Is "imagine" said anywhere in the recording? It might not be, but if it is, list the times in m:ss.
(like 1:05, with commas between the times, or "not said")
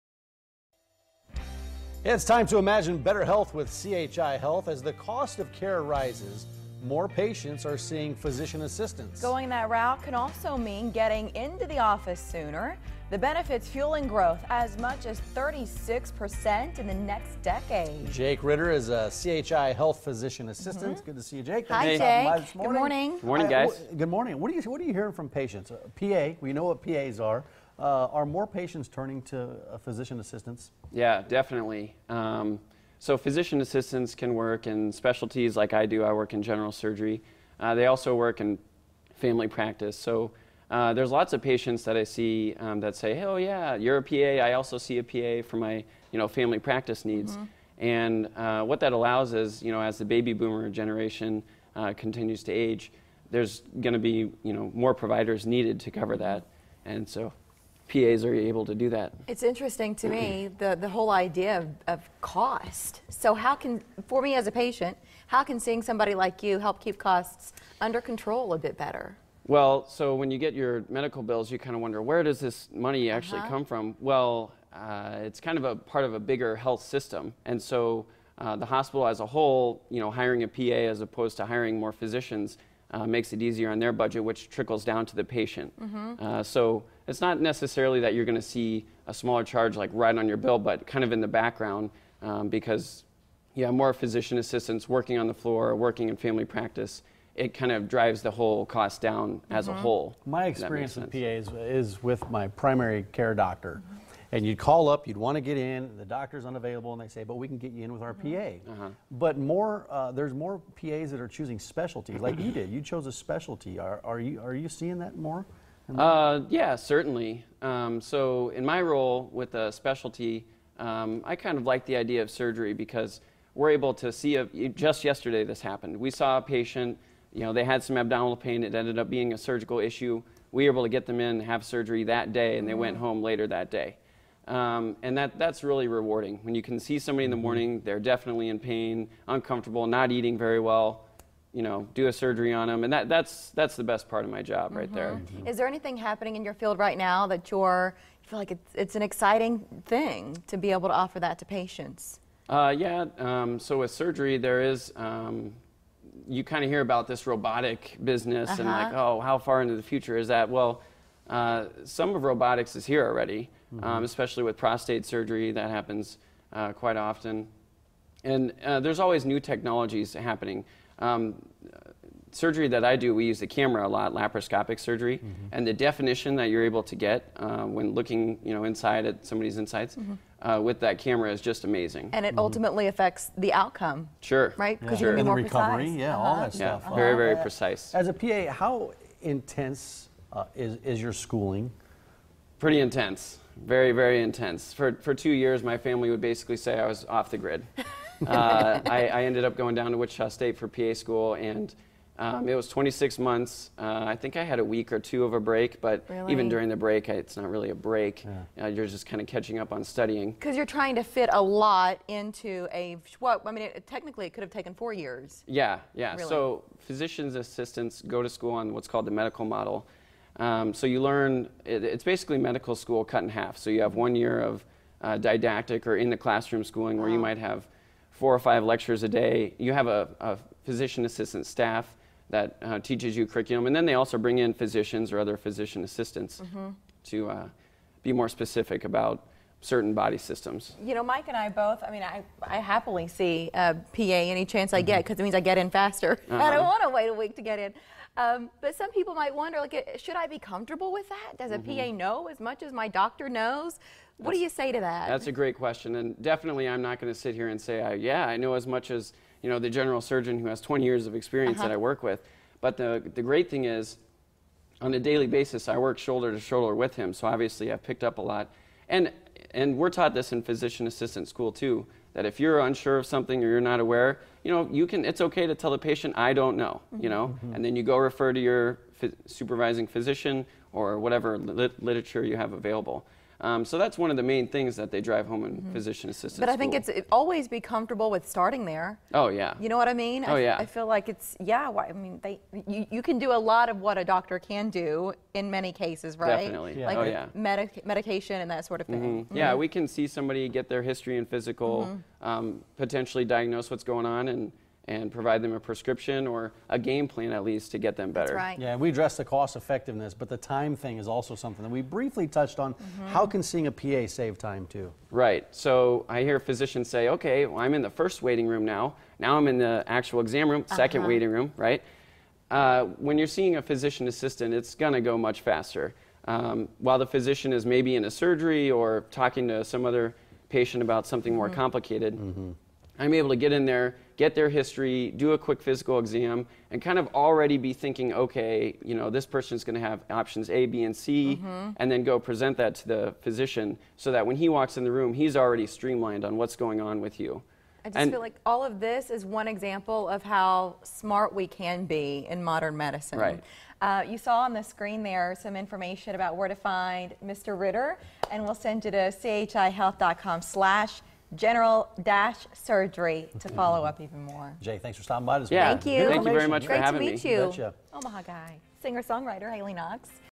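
0:02.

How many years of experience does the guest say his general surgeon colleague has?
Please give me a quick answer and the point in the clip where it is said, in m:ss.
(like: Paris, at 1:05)
20, at 4:20.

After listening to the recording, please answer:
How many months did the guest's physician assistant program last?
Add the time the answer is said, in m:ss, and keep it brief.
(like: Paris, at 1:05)
26, at 3:22.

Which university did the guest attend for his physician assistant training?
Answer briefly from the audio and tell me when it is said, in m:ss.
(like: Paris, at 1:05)
Wichita State, at 3:19.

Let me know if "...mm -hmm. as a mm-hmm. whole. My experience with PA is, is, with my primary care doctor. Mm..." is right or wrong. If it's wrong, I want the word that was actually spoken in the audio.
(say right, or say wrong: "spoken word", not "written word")
right.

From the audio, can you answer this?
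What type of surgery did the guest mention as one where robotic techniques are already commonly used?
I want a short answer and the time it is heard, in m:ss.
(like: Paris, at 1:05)
Prostate surgery, at 2:44.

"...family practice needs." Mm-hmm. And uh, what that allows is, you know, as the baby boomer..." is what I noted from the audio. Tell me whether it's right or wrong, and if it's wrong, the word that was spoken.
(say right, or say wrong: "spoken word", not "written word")
right.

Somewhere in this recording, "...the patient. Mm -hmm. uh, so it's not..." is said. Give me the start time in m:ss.
1:25.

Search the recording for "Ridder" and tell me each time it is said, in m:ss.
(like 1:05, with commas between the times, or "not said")
0:18, 5:57.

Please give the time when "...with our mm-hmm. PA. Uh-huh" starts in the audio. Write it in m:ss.
1:47.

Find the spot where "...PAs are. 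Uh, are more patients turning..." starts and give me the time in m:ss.
0:26.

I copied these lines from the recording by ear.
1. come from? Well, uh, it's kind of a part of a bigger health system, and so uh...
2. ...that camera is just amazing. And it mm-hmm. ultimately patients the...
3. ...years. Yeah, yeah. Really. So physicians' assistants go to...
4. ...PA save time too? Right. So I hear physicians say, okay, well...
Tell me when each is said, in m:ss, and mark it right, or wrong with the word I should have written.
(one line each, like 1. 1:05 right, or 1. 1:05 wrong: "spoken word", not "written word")
1. 1:13 right
2. 3:00 wrong: "affects", not "patients"
3. 3:34 right
4. 5:13 right.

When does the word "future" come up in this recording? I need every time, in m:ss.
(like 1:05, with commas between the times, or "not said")
2:39.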